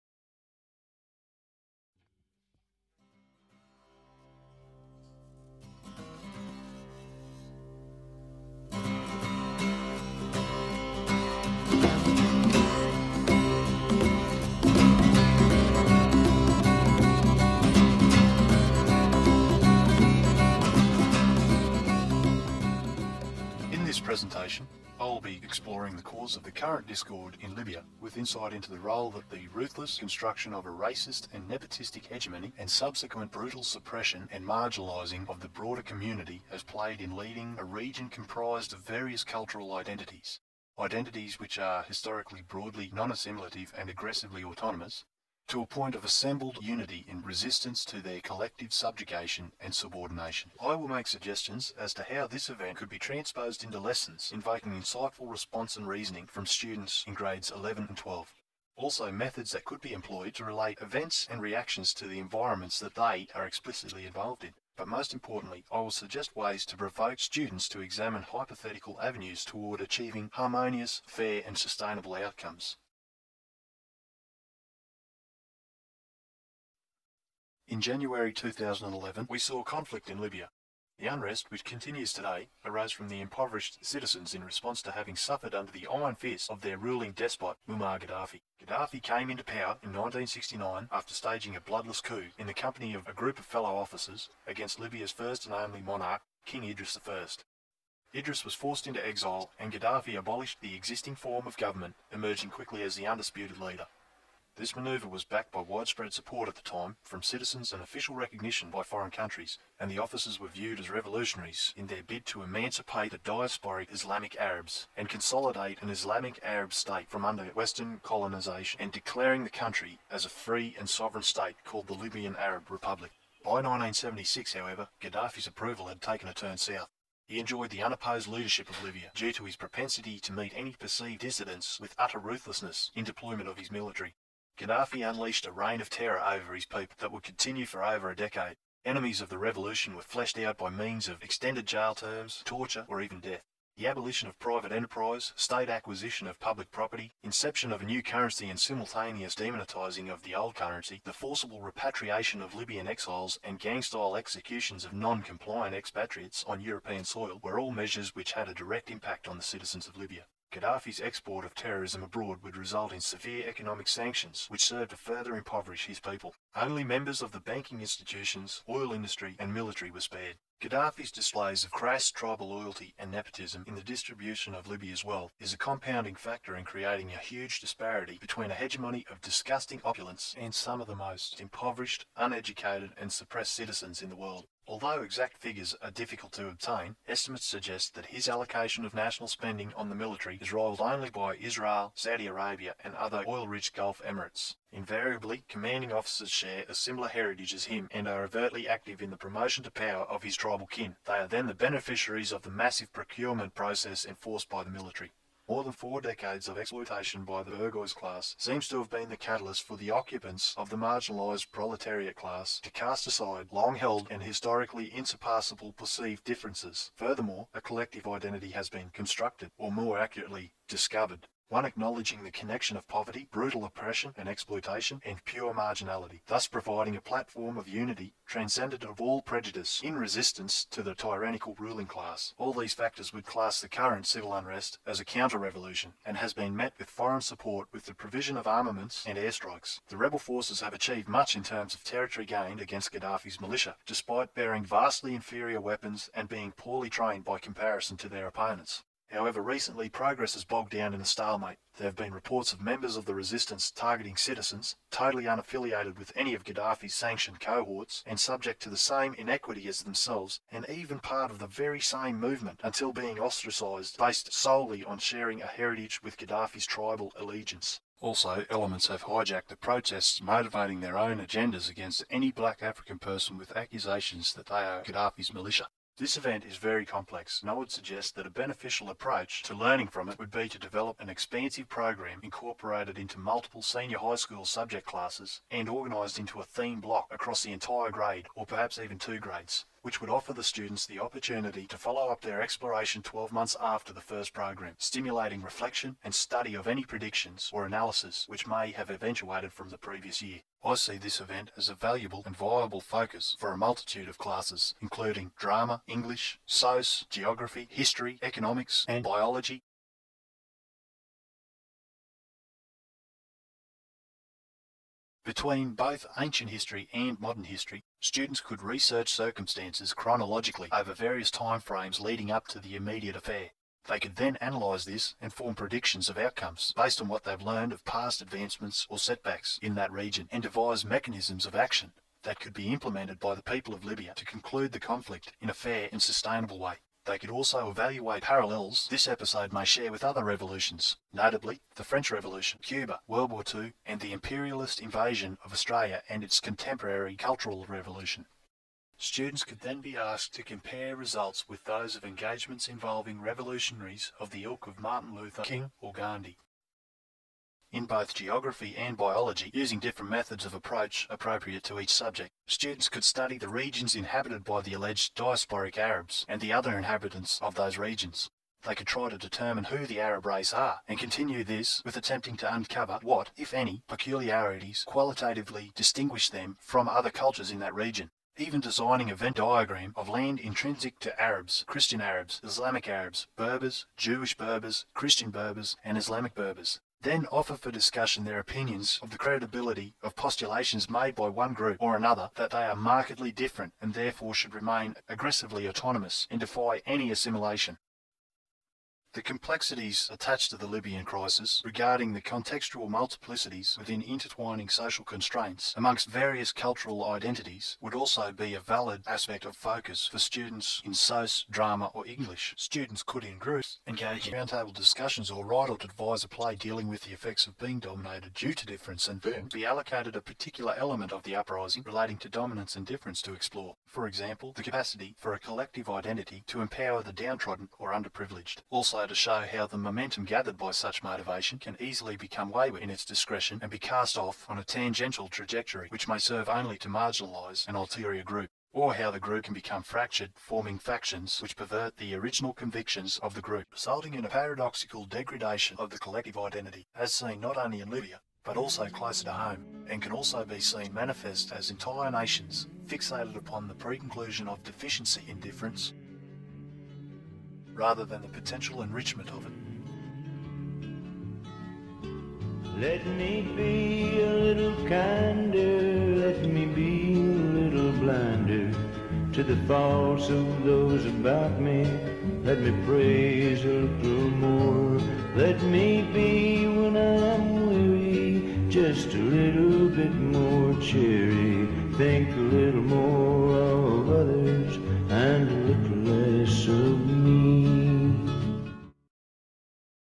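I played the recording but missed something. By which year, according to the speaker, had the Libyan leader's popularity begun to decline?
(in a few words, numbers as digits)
1976.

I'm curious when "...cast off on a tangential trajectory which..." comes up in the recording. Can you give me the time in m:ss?
7:13.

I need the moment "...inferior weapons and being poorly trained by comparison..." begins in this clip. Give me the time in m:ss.
4:05.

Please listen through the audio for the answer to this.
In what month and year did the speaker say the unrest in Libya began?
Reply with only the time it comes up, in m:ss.
1:17.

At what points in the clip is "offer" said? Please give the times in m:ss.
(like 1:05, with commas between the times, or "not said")
4:50, 6:27.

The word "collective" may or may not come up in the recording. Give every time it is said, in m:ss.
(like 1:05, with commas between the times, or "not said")
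0:48, 3:37, 7:05, 7:25.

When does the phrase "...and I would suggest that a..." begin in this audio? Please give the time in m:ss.
4:37.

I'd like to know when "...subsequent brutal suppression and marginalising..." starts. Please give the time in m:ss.
0:32.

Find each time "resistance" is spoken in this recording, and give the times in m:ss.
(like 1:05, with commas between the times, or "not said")
0:47, 3:49, 4:13.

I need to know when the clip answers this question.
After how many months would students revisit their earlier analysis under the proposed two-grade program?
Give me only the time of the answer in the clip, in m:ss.
4:53.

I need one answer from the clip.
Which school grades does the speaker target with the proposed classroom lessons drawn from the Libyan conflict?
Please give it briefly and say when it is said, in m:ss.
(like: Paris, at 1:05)
11 and 12, at 0:57.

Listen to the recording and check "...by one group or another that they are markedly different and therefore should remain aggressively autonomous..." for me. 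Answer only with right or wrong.
right.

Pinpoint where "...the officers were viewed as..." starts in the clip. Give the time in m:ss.
1:49.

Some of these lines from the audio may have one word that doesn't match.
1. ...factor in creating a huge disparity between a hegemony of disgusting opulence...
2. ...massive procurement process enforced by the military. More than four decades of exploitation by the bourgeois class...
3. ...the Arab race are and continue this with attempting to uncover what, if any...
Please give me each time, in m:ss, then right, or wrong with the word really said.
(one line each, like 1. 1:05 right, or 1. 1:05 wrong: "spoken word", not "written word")
1. 2:56 right
2. 3:22 right
3. 6:09 right.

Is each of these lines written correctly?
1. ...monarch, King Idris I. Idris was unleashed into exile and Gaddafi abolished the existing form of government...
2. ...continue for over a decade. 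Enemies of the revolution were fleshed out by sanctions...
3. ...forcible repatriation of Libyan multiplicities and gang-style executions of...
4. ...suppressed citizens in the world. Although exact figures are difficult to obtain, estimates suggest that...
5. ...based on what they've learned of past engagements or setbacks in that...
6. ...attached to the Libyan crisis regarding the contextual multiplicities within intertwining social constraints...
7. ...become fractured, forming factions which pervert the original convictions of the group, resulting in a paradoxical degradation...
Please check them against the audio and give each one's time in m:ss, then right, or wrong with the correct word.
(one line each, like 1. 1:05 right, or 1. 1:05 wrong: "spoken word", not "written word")
1. 1:35 wrong: "forced", not "unleashed"
2. 2:17 wrong: "means", not "sanctions"
3. 2:31 wrong: "exiles", not "multiplicities"
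4. 3:03 right
5. 5:26 wrong: "advancements", not "engagements"
6. 6:40 right
7. 7:19 right.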